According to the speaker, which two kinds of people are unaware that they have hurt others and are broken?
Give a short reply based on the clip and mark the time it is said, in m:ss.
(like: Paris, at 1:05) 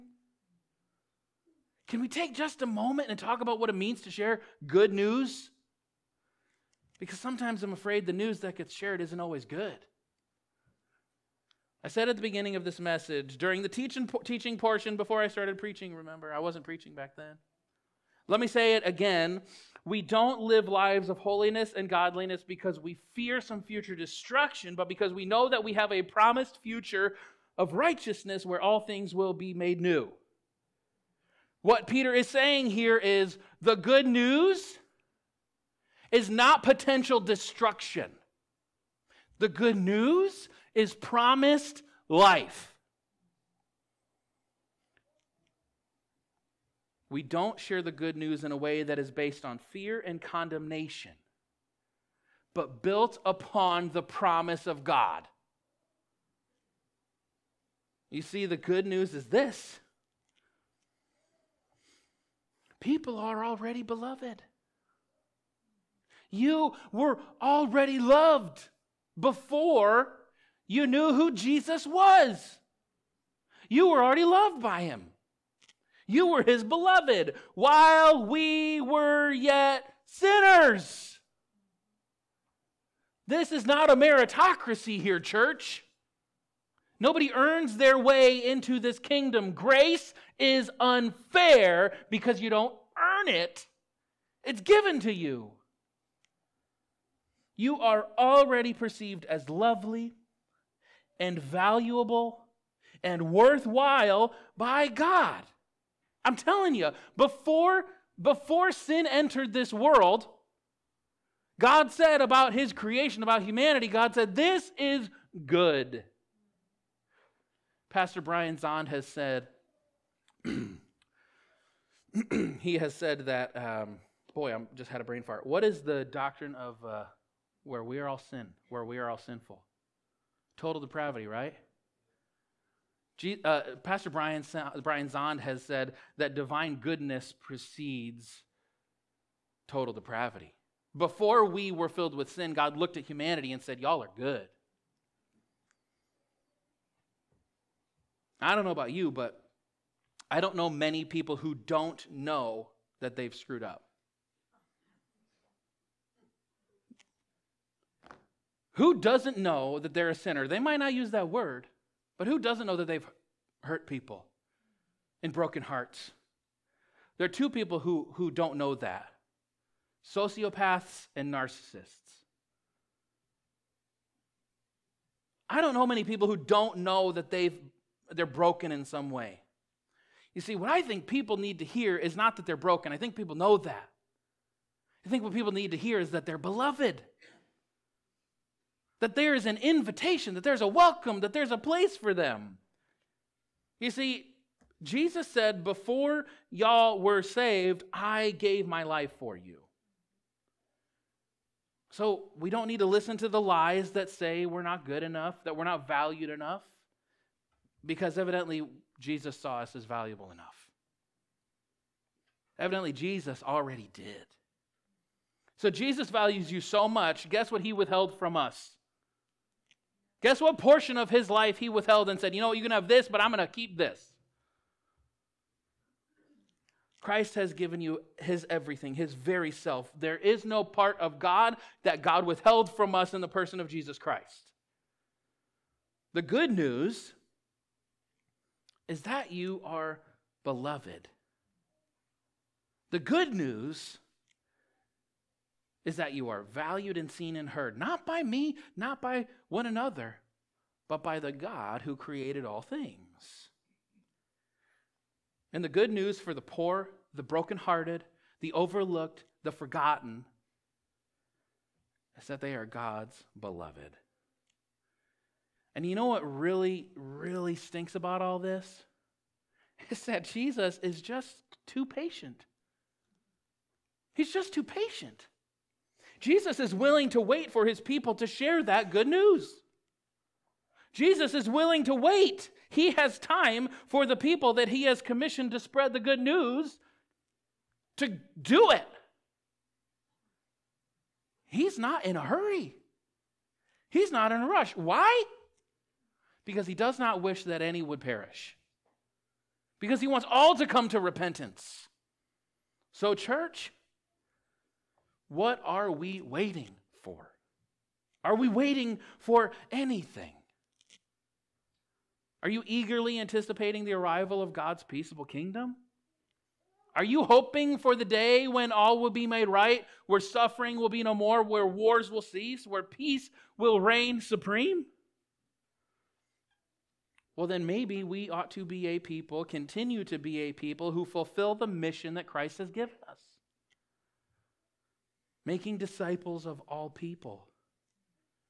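Sociopaths and narcissists, at 2:50.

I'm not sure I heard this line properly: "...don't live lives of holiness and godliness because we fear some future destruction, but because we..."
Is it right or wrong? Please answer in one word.
right.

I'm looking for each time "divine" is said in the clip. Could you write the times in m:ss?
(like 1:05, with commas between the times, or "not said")
2:16.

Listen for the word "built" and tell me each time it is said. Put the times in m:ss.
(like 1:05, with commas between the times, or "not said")
0:52.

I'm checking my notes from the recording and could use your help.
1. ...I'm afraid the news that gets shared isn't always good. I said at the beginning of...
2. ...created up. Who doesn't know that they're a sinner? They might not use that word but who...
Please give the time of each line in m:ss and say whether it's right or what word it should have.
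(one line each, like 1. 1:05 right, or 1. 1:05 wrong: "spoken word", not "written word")
1. 0:07 right
2. 2:33 wrong: "screwed", not "created".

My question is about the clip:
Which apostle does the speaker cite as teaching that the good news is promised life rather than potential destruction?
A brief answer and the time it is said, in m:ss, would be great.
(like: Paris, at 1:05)
Peter, at 0:31.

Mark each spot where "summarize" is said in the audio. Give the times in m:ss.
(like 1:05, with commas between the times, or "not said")
not said.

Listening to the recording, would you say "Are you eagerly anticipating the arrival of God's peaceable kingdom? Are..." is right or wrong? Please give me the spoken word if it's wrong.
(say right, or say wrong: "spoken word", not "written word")
right.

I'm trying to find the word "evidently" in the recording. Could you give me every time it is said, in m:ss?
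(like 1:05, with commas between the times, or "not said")
3:28, 3:32.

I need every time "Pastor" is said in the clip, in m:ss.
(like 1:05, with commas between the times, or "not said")
1:57, 2:13.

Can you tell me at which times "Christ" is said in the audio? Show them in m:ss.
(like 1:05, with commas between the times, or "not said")
3:47, 3:53, 5:32.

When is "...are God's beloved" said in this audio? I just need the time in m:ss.
4:22.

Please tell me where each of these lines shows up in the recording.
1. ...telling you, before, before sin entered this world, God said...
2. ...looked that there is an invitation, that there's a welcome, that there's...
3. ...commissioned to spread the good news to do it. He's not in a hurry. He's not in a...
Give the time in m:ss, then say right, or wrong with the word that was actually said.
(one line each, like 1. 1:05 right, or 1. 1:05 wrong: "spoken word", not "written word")
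1. 1:46 right
2. 3:06 wrong: "beloved", not "looked"
3. 4:45 right.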